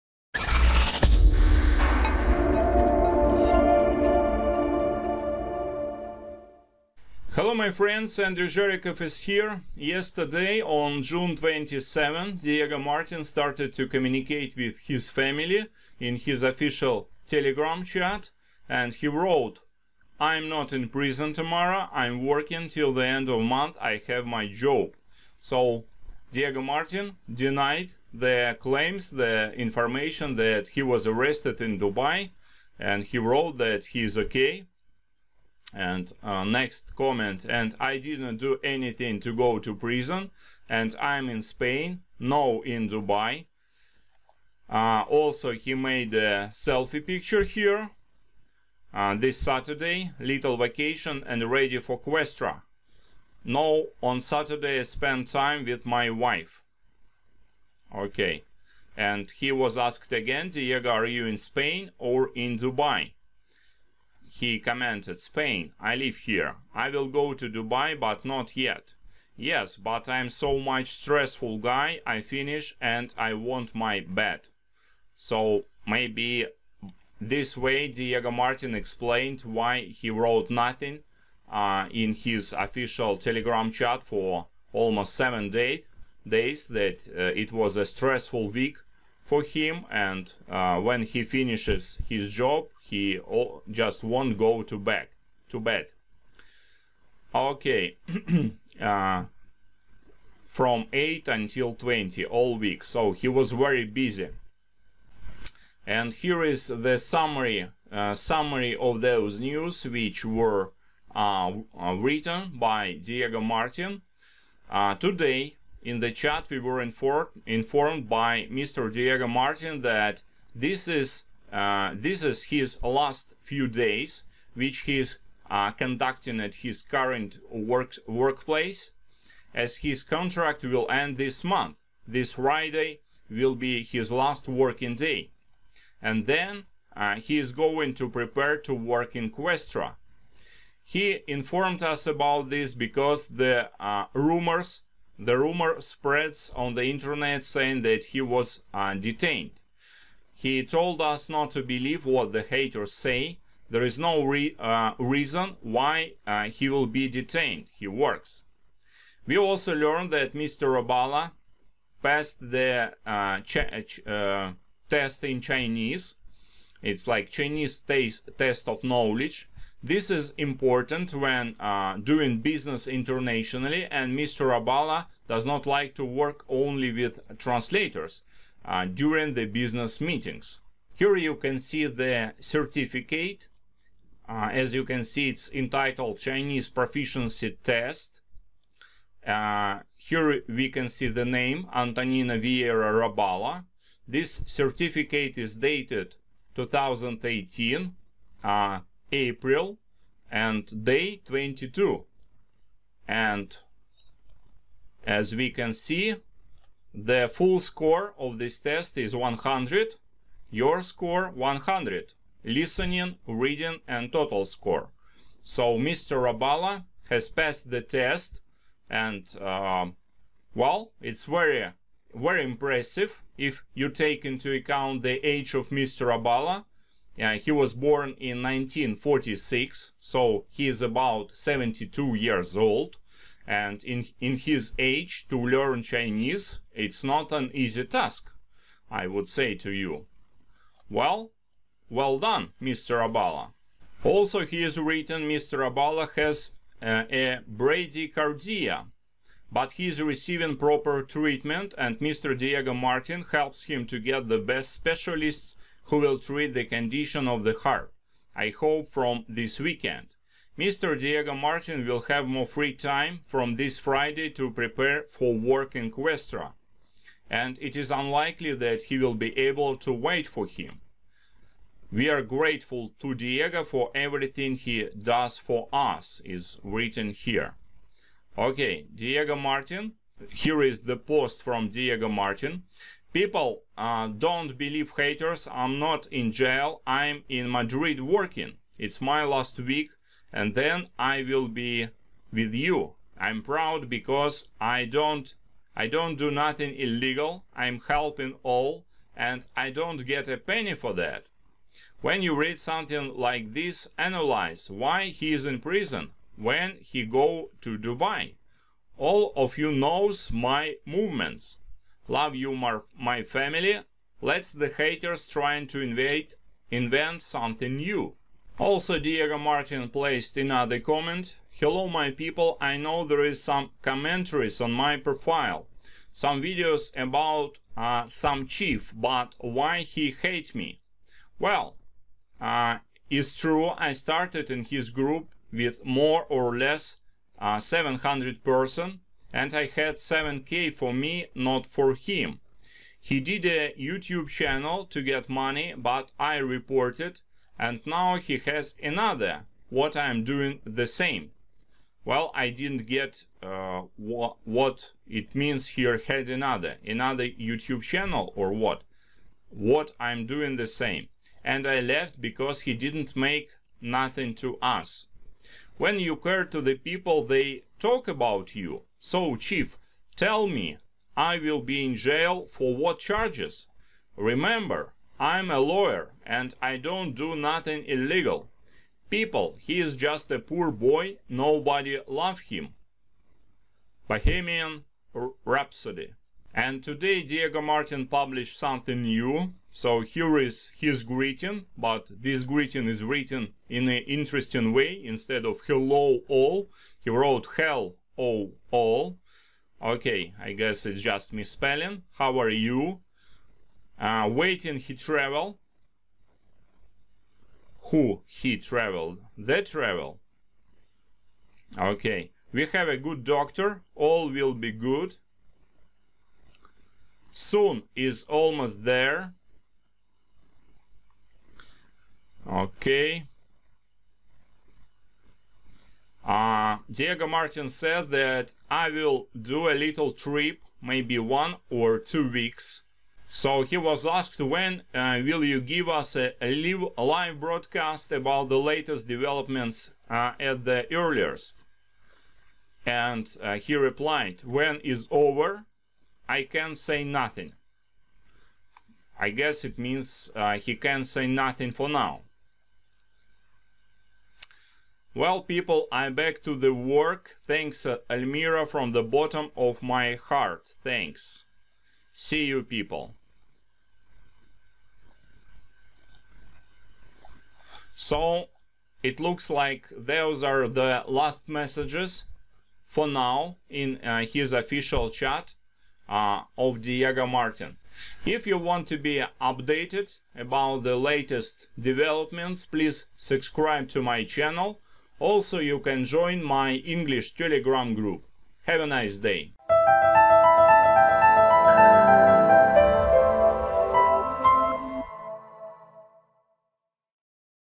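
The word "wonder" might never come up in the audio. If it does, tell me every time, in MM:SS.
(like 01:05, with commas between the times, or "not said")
not said.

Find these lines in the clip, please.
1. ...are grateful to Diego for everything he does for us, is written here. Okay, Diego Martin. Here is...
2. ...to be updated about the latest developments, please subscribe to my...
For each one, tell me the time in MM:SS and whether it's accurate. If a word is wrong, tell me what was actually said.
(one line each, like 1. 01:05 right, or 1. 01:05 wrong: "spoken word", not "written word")
1. 04:32 right
2. 07:58 right.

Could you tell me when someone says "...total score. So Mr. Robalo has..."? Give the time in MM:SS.
03:34.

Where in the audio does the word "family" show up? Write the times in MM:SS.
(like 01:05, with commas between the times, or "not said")
00:15, 05:13.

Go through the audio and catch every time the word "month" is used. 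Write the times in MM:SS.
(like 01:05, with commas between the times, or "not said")
00:23, 02:11.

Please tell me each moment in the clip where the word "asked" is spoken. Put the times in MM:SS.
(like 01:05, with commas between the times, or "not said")
00:59, 07:14.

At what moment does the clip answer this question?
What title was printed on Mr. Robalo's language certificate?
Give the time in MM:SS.
03:06.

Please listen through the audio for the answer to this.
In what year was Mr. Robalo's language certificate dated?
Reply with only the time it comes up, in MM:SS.
03:16.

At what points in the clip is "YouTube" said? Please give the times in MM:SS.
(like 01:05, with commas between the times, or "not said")
05:43, 05:57.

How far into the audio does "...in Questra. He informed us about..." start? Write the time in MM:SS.
02:19.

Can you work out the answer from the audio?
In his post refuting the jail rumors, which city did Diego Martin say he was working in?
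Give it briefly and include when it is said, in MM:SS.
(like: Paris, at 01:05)
Madrid, at 04:47.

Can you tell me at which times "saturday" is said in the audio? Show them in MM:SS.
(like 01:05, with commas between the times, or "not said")
00:49, 00:54.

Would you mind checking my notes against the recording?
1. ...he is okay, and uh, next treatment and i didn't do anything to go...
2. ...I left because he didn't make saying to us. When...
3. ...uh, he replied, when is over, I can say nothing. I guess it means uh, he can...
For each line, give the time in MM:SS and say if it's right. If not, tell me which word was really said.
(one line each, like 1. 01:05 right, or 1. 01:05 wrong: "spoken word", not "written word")
1. 00:33 wrong: "comment", not "treatment"
2. 06:01 wrong: "nothing", not "saying"
3. 07:23 right.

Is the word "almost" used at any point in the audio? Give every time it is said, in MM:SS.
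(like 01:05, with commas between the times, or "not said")
01:24, 06:58.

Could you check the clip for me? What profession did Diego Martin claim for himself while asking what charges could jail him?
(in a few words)
Lawyer.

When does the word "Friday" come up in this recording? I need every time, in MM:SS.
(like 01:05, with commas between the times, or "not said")
02:12, 04:23.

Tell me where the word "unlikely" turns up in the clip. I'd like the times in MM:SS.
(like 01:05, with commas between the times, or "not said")
04:27.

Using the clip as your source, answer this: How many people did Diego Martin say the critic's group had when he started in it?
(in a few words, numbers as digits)
700.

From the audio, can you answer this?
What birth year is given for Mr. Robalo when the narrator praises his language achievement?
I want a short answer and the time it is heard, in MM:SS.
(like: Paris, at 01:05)
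1946, at 03:48.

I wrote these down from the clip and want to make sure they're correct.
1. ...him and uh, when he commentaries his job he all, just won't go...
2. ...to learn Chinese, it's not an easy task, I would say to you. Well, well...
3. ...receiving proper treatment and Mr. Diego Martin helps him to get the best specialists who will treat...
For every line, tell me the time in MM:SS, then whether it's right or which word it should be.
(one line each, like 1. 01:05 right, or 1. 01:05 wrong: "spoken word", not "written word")
1. 01:29 wrong: "finishes", not "commentaries"
2. 03:55 right
3. 04:10 right.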